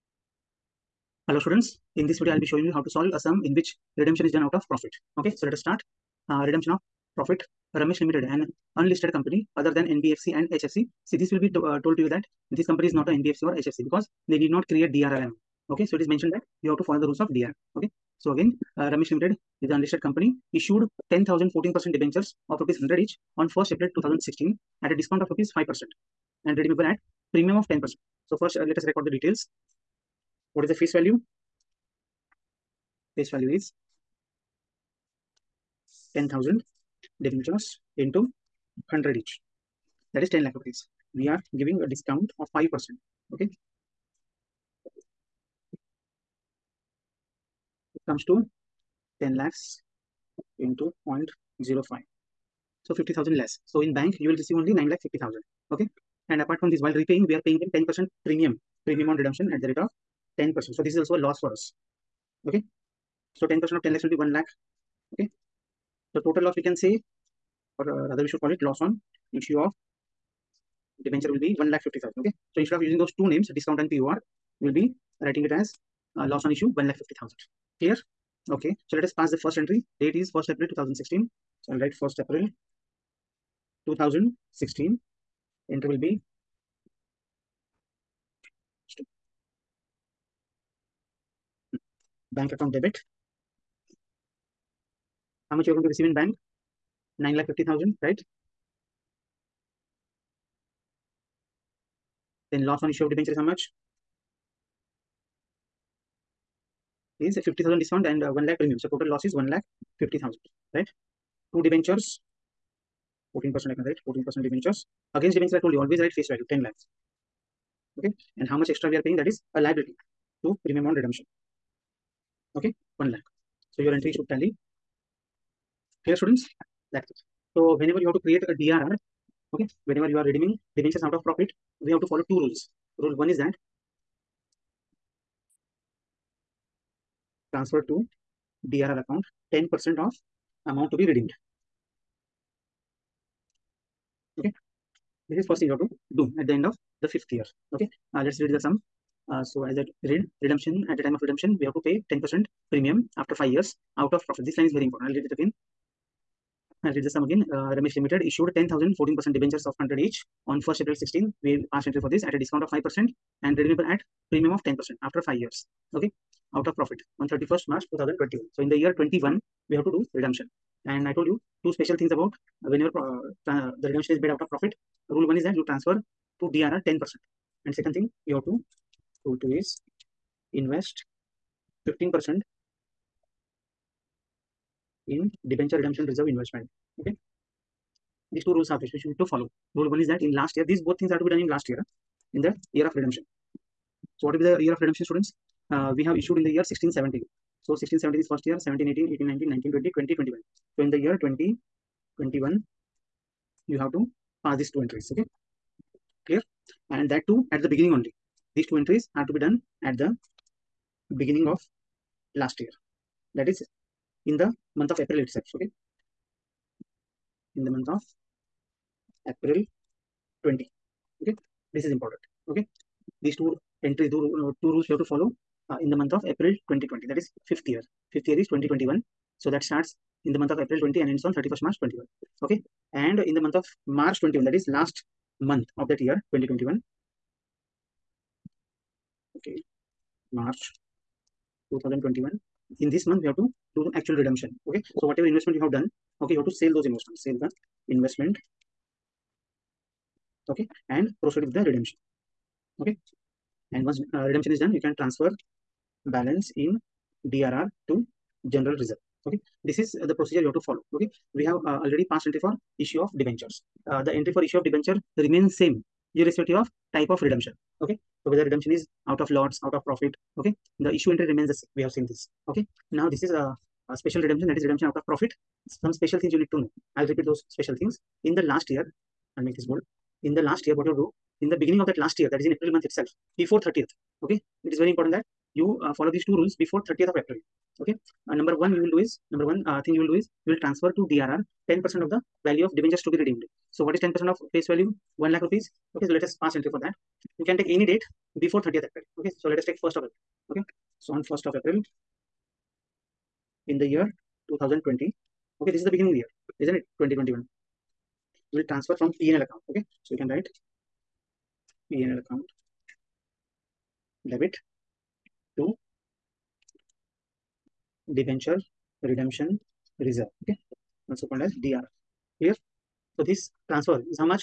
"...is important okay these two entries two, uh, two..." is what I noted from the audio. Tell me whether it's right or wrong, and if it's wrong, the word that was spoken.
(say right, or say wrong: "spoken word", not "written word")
right.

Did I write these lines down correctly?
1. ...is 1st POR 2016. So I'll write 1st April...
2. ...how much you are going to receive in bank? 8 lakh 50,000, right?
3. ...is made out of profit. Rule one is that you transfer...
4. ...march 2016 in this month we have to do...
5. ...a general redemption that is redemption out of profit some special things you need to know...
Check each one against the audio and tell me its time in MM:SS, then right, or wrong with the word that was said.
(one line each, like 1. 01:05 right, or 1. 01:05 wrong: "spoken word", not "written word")
1. 01:20 wrong: "April", not "POR"
2. 01:35 wrong: "9", not "8"
3. 02:54 right
4. 04:00 wrong: "2021", not "2016"
5. 04:33 wrong: "special", not "general".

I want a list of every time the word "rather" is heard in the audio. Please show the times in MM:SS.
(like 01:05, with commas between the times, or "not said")
01:08.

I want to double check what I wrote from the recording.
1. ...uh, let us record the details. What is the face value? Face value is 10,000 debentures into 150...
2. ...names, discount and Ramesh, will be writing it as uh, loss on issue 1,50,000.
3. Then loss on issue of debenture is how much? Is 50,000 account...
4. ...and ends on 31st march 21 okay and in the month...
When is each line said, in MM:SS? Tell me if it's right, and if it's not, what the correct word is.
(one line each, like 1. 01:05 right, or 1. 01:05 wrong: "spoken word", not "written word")
1. 00:28 wrong: "100", not "150"
2. 01:13 wrong: "POR", not "Ramesh"
3. 01:42 wrong: "discount", not "account"
4. 03:51 right.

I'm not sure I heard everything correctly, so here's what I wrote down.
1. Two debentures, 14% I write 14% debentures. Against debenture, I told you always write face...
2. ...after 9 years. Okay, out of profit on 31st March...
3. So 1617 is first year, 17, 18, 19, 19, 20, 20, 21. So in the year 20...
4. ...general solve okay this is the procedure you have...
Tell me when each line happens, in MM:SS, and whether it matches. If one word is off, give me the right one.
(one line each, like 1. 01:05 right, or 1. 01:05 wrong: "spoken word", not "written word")
1. 01:51 right
2. 02:45 wrong: "5", not "9"
3. 03:17 right
4. 04:18 wrong: "reserve", not "solve".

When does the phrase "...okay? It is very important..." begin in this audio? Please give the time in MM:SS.
04:44.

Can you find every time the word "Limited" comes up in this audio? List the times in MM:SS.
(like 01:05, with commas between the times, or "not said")
00:07, 00:19, 02:37.